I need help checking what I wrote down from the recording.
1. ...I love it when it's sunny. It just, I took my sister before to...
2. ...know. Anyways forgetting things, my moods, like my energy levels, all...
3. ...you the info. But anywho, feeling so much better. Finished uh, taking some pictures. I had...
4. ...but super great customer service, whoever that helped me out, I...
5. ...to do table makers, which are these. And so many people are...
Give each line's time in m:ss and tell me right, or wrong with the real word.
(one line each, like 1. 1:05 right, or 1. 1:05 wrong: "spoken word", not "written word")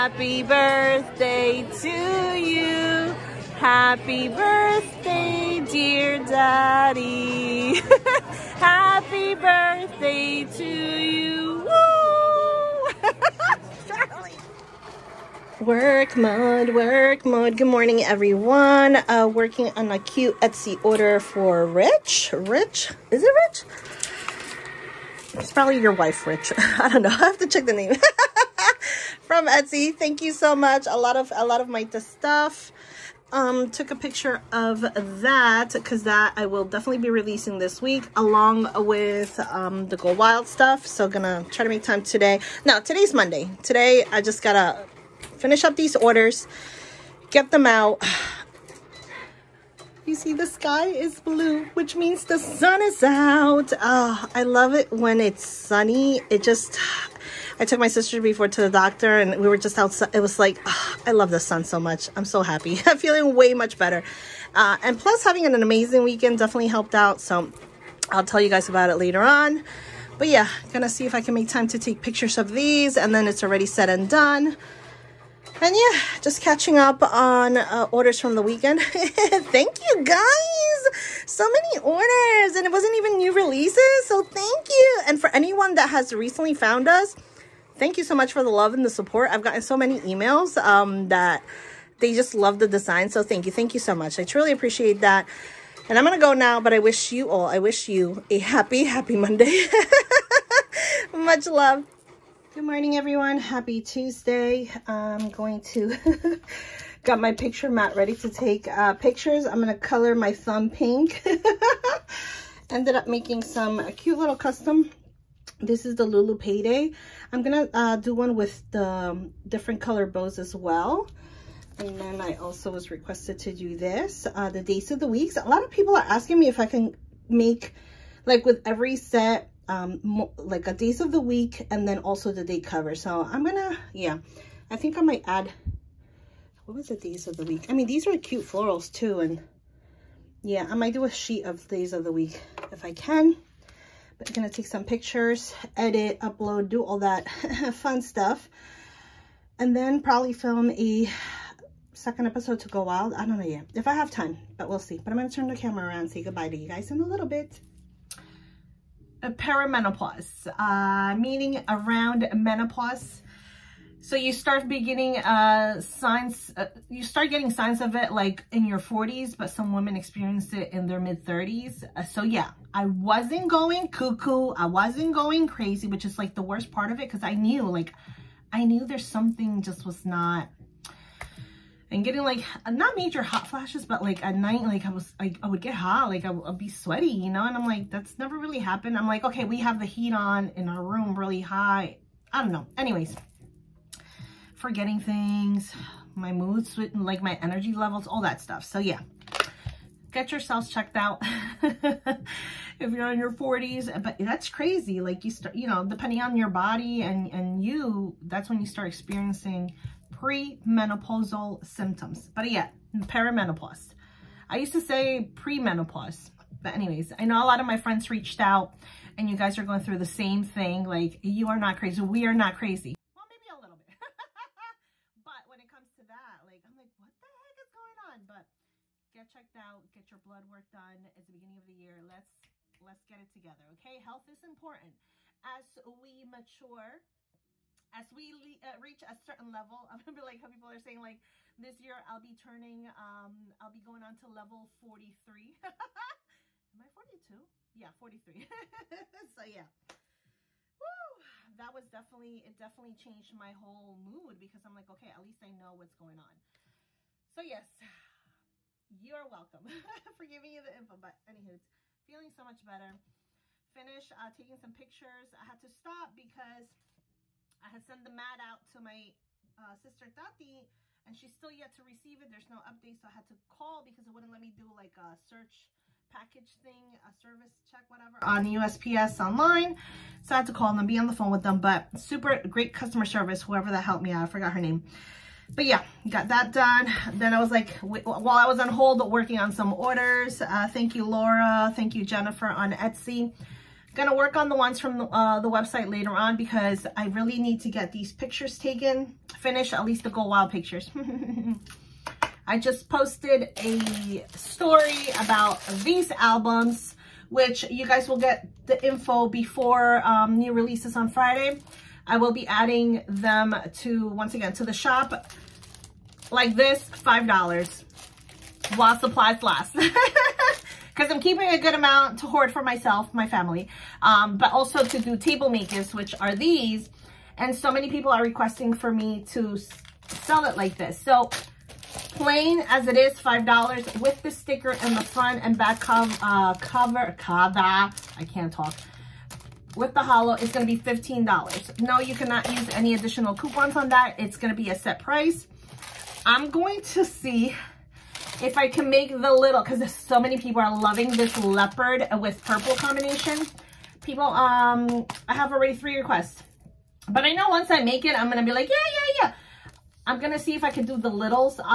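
1. 0:54 right
2. 3:12 right
3. 4:20 right
4. 4:41 right
5. 5:24 right.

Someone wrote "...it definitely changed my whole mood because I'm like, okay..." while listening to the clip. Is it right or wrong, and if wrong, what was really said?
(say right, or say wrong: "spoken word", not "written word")
right.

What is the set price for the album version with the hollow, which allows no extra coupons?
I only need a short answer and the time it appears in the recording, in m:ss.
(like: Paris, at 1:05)
$15, at 5:40.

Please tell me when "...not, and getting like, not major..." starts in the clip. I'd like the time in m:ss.
3:00.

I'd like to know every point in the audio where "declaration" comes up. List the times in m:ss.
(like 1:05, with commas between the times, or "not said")
not said.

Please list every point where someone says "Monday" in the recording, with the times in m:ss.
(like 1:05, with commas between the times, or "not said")
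0:43, 1:39.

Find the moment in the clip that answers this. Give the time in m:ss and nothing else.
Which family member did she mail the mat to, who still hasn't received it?
4:29.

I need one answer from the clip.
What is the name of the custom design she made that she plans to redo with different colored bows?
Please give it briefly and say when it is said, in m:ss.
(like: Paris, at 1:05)
Lulu Payday, at 1:56.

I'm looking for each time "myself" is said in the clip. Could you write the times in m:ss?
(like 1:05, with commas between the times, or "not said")
5:22.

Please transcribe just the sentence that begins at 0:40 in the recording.
So gonna try to make time today.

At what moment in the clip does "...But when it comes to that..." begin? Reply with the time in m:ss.
3:45.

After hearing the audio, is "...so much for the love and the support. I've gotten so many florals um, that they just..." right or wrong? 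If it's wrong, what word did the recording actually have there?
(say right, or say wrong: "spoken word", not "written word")
wrong: "emails", not "florals".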